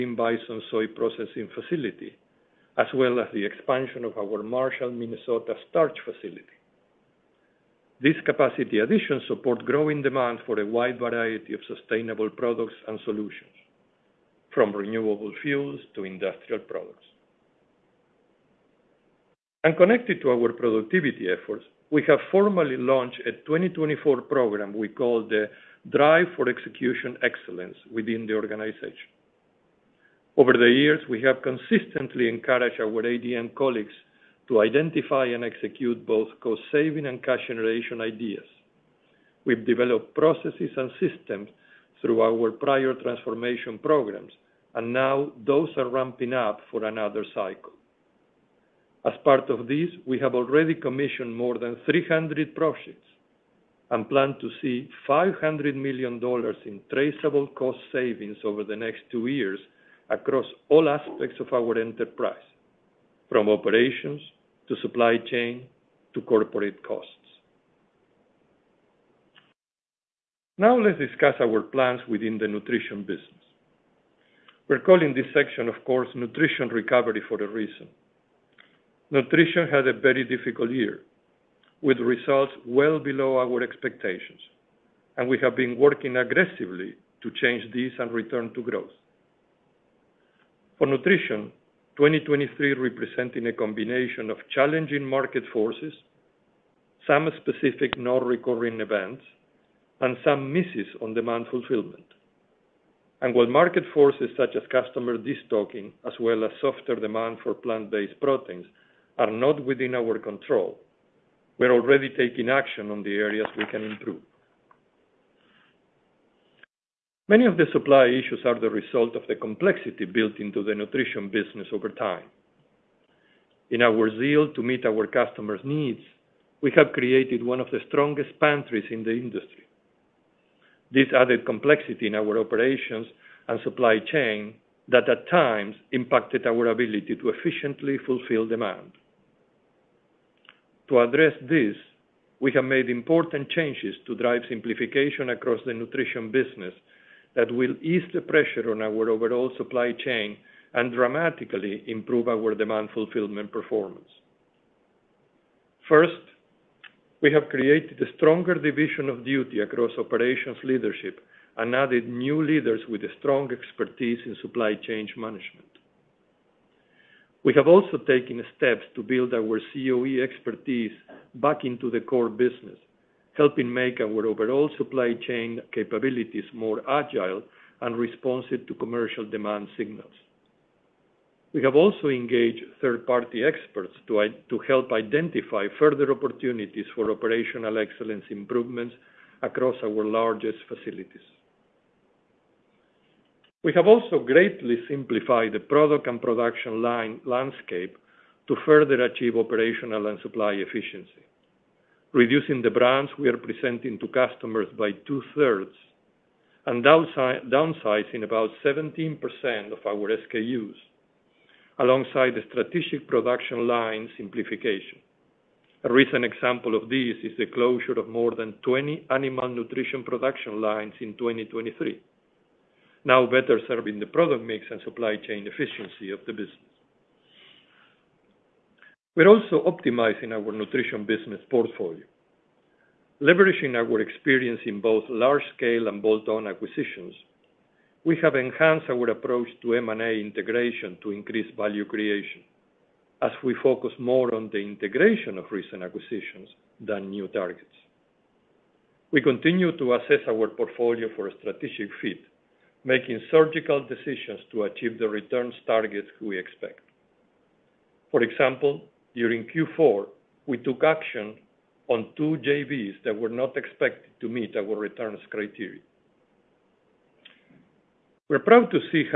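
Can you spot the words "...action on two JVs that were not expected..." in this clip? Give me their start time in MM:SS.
04:20.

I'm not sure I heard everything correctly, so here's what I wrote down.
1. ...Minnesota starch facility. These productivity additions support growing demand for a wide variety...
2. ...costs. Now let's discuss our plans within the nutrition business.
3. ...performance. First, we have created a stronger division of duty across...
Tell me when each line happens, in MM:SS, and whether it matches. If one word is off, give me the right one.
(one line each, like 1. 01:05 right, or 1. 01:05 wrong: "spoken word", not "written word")
1. 00:04 wrong: "capacity", not "productivity"
2. 01:06 right
3. 02:33 right.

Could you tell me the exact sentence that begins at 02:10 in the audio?
This added complexity in our operations and supply chain that at times impacted our ability to efficiently fulfill demand.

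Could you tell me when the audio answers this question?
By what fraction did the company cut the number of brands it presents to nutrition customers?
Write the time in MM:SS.
03:25.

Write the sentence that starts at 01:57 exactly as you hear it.
Many of the supply issues are the result of the complexity built into the nutrition business over time.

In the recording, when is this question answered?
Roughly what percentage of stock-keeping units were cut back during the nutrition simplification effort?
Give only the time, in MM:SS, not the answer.
03:28.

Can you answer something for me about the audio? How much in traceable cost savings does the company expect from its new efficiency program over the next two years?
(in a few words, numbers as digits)
$500 million.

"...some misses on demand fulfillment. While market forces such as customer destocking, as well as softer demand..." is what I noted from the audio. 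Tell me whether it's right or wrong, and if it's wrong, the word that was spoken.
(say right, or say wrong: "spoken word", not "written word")
right.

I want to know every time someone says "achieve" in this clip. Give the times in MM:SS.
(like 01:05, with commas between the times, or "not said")
03:19, 04:14.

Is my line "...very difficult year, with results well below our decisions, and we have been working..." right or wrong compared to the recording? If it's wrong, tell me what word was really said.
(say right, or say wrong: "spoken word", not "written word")
wrong: "expectations", not "decisions".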